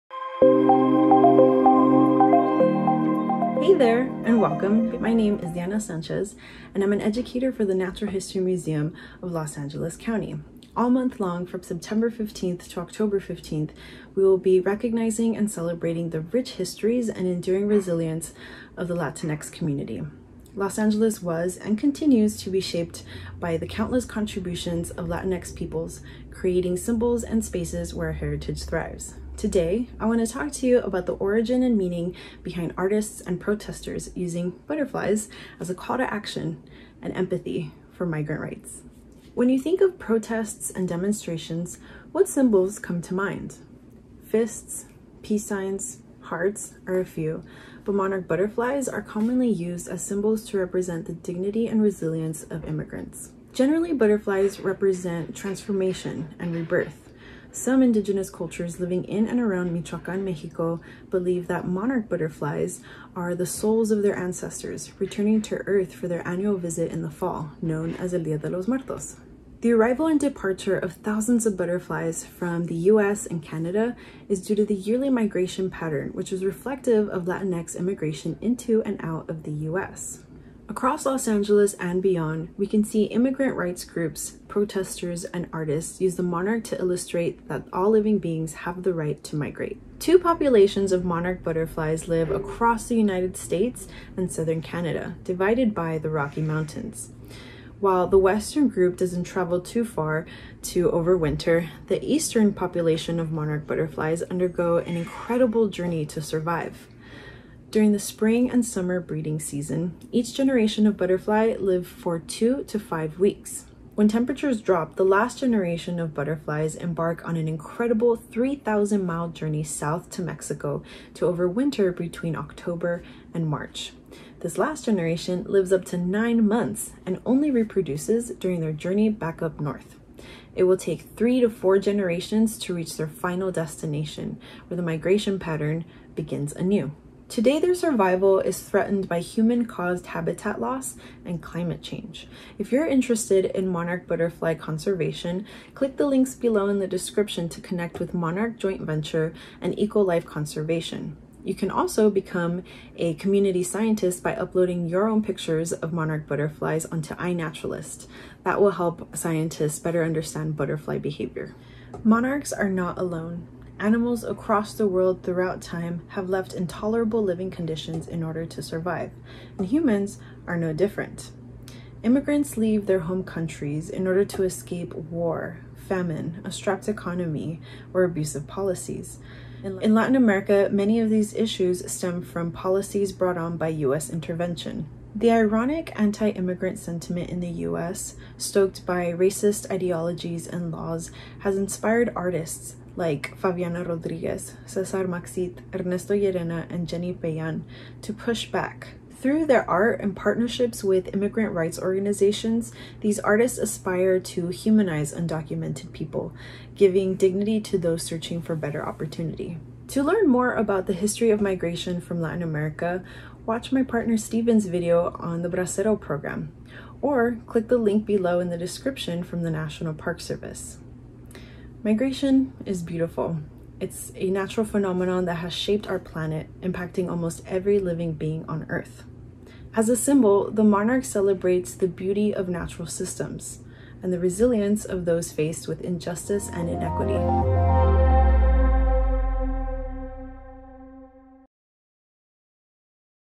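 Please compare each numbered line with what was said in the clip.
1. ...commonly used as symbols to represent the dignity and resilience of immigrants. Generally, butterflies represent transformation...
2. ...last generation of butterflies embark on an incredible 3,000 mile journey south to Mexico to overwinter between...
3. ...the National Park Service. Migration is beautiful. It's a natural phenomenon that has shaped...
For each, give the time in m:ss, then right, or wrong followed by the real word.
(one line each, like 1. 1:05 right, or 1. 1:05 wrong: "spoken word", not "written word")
1. 0:49 right
2. 1:55 right
3. 3:39 right.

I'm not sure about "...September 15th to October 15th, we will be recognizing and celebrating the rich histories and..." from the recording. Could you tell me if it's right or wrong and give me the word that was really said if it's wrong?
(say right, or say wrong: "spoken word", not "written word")
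right.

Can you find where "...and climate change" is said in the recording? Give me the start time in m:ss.
2:21.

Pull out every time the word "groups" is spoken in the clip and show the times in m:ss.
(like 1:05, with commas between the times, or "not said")
1:23, 1:38.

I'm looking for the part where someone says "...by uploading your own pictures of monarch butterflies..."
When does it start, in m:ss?
2:34.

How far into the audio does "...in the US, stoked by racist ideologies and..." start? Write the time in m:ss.
3:07.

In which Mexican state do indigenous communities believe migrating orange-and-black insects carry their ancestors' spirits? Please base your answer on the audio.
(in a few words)
Michoacan.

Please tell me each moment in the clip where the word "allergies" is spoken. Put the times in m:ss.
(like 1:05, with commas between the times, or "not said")
not said.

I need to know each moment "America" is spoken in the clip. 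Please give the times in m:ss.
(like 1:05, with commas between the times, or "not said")
3:00, 3:32.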